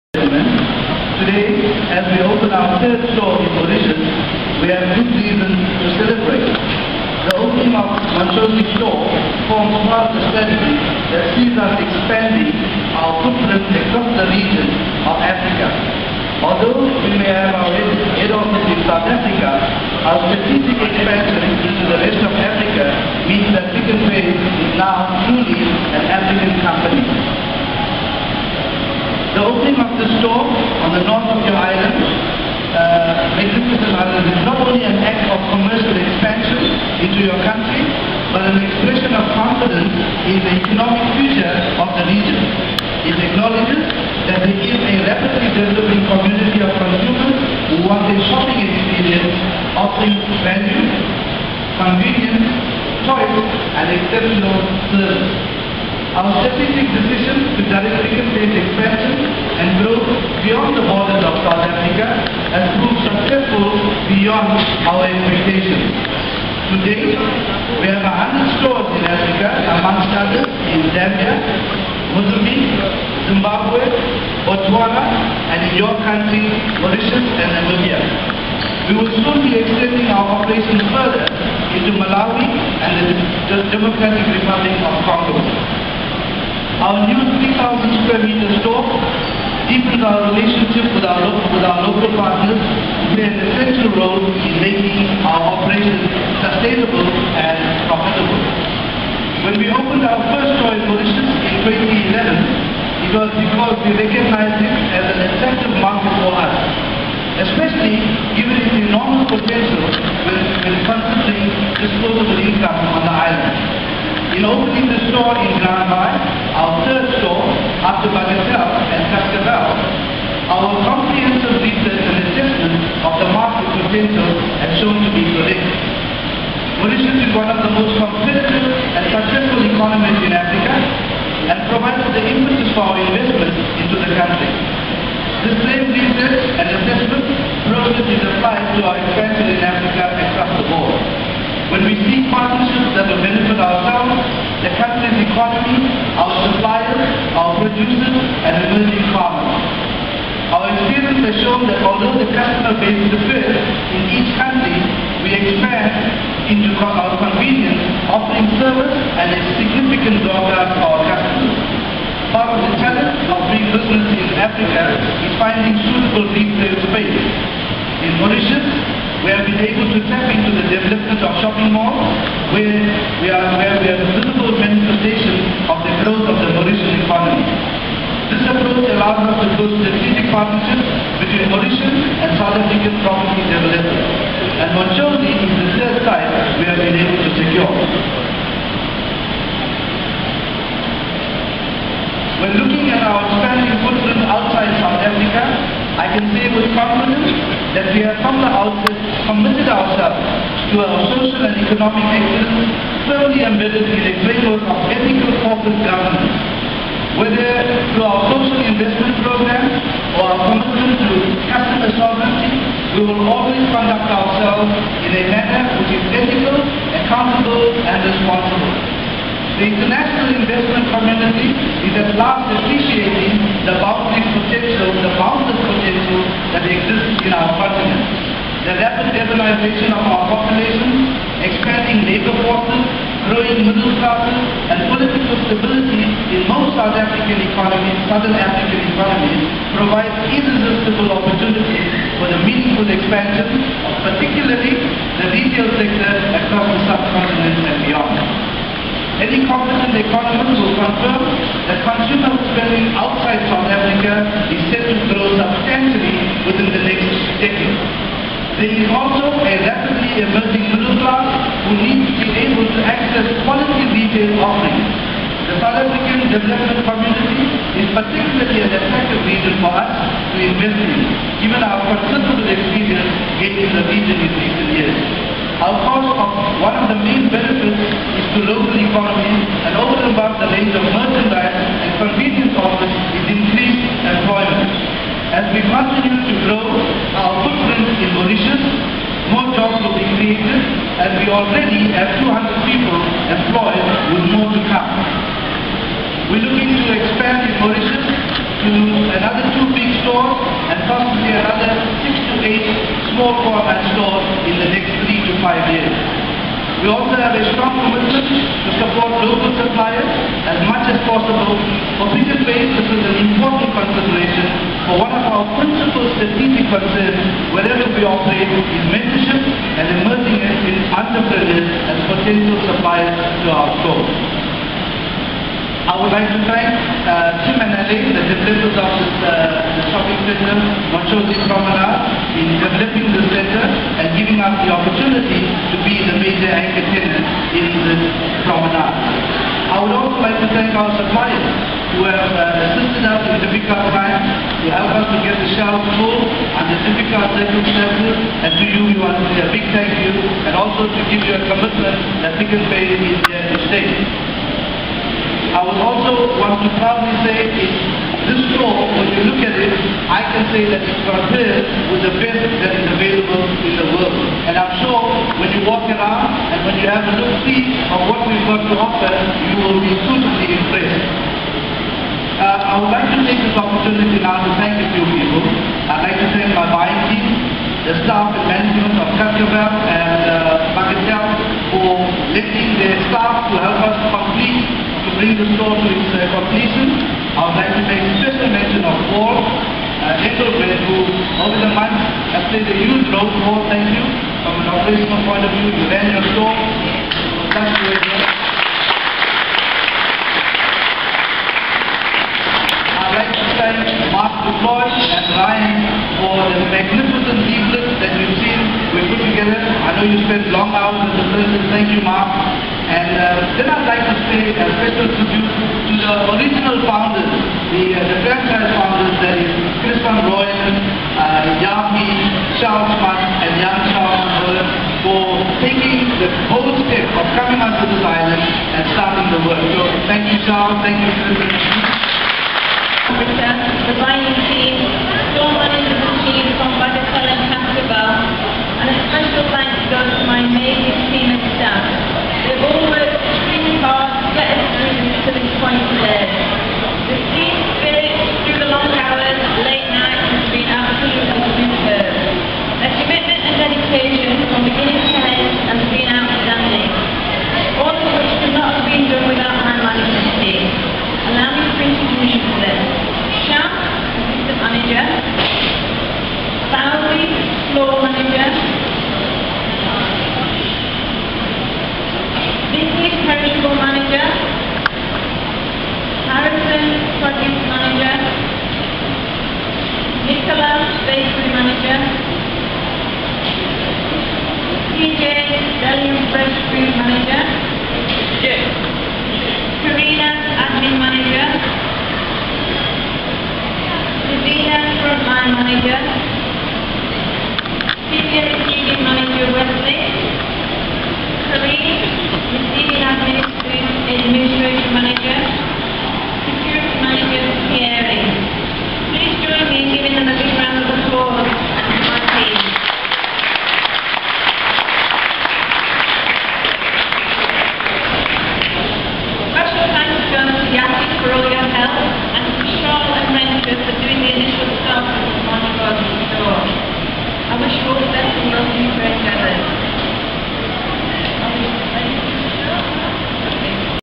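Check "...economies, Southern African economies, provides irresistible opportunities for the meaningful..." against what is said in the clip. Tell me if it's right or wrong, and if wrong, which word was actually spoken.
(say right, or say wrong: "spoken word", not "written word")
right.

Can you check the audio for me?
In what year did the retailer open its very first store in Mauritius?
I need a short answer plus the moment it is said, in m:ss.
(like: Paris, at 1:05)
2011, at 1:43.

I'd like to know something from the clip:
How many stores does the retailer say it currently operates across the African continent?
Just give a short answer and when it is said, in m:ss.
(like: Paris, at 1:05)
100, at 1:08.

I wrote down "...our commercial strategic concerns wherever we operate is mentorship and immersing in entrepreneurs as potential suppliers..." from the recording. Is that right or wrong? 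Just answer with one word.
wrong.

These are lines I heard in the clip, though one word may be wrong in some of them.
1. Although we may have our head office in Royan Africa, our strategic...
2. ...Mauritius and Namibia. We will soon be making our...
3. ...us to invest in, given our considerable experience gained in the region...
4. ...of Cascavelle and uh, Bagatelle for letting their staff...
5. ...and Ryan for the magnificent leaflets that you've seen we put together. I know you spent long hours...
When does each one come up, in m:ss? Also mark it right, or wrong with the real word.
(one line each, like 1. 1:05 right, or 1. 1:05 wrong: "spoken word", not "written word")
1. 0:16 wrong: "South", not "Royan"
2. 1:16 wrong: "extending", not "making"
3. 4:29 right
4. 6:18 right
5. 6:44 right.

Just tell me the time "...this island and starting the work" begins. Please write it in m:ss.
7:07.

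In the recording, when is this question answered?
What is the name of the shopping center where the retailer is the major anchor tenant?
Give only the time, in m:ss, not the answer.
5:30.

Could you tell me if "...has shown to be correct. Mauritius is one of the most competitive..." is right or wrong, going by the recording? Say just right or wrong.
right.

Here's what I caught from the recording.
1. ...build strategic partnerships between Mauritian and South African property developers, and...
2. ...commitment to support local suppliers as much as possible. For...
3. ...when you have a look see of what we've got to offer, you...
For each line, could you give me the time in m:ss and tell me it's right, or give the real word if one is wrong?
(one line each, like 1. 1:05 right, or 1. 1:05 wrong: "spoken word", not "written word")
1. 2:59 right
2. 5:07 right
3. 6:06 right.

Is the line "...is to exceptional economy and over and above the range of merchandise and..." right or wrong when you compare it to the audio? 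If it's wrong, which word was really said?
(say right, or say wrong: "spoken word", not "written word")
wrong: "local", not "exceptional".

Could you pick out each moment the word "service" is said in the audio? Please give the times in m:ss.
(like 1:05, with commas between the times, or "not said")
0:54, 2:38.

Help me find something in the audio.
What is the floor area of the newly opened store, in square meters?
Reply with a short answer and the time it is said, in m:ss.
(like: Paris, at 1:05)
3,000, at 1:27.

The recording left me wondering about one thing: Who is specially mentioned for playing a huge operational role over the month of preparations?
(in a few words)
Engelbert.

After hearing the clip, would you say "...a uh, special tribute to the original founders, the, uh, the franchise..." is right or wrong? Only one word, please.
right.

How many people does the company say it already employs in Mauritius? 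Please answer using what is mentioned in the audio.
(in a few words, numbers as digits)
200.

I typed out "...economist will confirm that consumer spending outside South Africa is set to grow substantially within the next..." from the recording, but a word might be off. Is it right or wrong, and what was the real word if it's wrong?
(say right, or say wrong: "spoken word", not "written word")
right.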